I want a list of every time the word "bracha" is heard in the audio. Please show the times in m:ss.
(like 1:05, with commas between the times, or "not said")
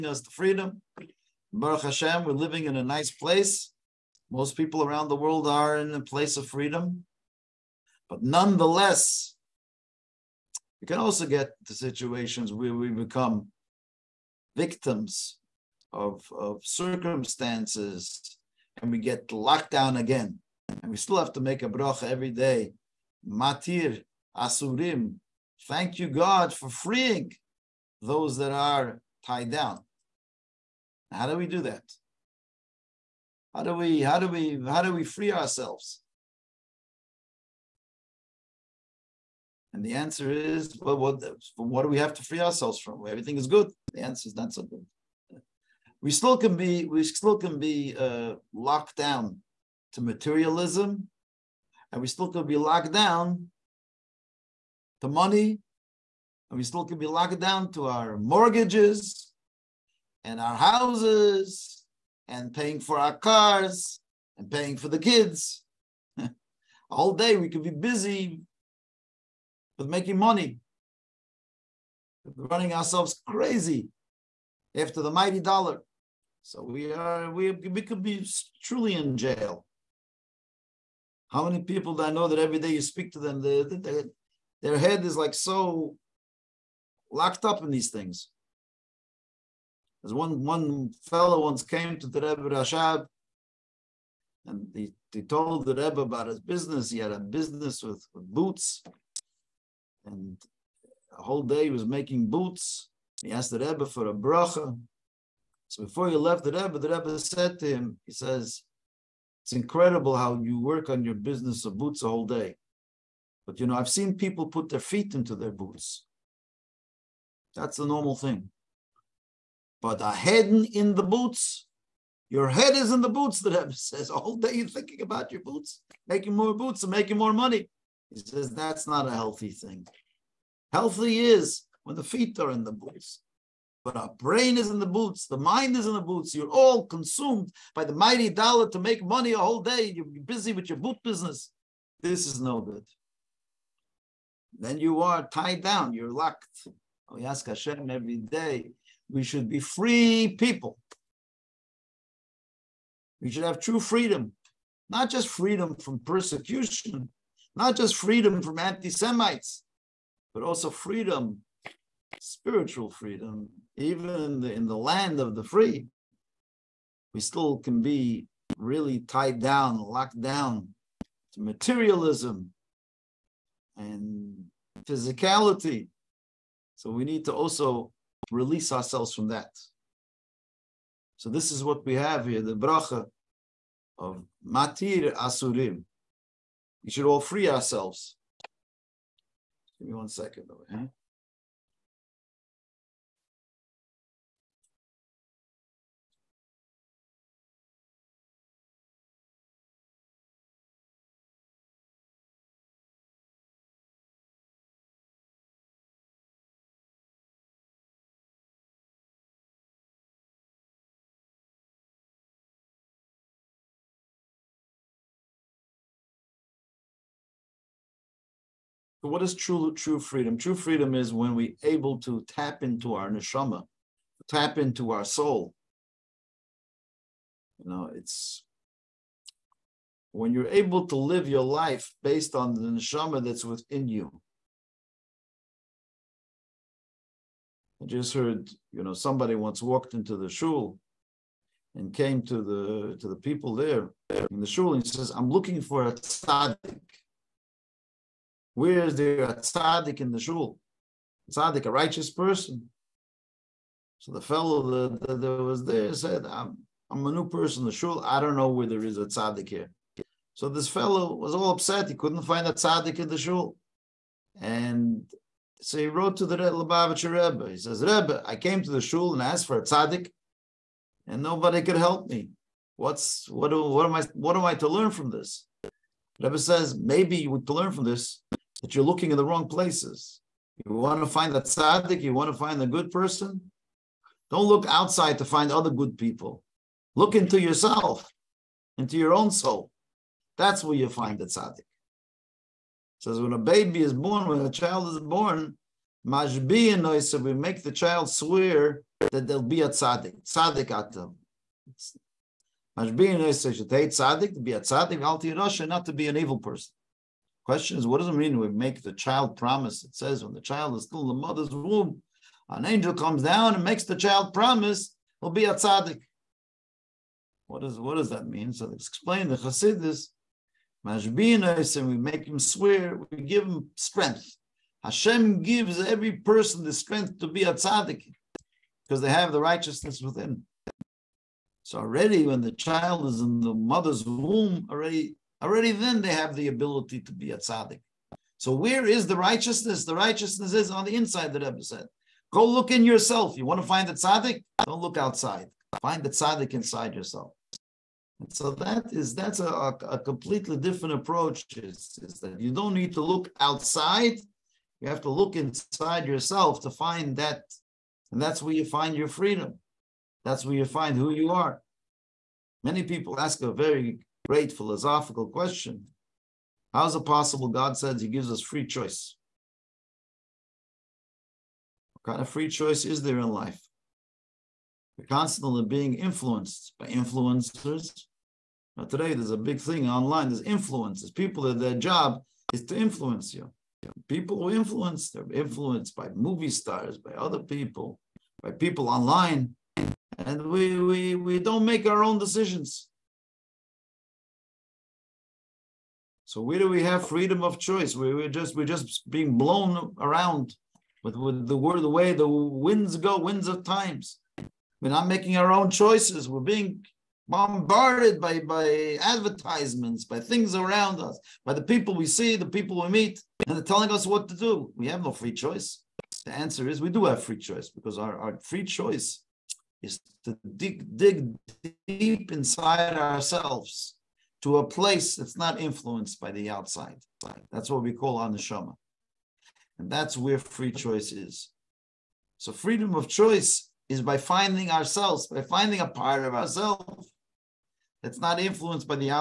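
0:21, 1:44, 3:02.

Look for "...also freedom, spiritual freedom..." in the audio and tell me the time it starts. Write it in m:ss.
2:40.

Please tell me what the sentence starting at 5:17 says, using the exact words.
What, is, what does that mean?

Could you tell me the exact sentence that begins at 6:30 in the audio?
And we, we, we don't make our own decisions.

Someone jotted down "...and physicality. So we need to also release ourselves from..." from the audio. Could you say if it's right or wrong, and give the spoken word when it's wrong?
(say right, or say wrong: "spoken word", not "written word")
right.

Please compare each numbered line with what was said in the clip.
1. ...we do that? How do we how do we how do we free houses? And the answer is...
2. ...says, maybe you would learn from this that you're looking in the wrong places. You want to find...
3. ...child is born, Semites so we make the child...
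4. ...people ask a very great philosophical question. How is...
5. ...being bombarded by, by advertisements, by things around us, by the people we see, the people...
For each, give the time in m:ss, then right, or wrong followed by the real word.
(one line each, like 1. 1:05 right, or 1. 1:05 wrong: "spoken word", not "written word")
1. 0:31 wrong: "ourselves", not "houses"
2. 4:36 right
3. 4:54 wrong: "Majbi", not "Semites"
4. 6:02 right
5. 6:46 right.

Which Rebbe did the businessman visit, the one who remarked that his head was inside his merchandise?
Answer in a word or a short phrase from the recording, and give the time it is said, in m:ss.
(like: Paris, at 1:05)
Rebbe Rashab, at 1:32.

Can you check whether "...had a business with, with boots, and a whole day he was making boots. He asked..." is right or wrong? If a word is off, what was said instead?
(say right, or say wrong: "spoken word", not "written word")
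right.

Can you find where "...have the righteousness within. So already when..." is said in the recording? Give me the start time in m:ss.
5:29.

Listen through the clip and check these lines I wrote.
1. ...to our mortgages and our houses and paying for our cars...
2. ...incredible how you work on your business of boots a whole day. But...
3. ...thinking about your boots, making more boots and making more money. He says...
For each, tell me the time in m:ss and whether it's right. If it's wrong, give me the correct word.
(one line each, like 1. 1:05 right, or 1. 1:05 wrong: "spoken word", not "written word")
1. 0:57 right
2. 1:49 right
3. 2:04 right.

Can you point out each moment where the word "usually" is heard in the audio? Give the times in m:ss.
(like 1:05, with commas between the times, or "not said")
not said.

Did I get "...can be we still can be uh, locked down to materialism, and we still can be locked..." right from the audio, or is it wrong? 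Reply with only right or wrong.
right.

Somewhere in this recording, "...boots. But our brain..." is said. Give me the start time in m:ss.
2:12.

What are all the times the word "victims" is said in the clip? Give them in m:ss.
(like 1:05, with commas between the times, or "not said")
0:14.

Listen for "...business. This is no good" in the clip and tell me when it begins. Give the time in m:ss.
2:21.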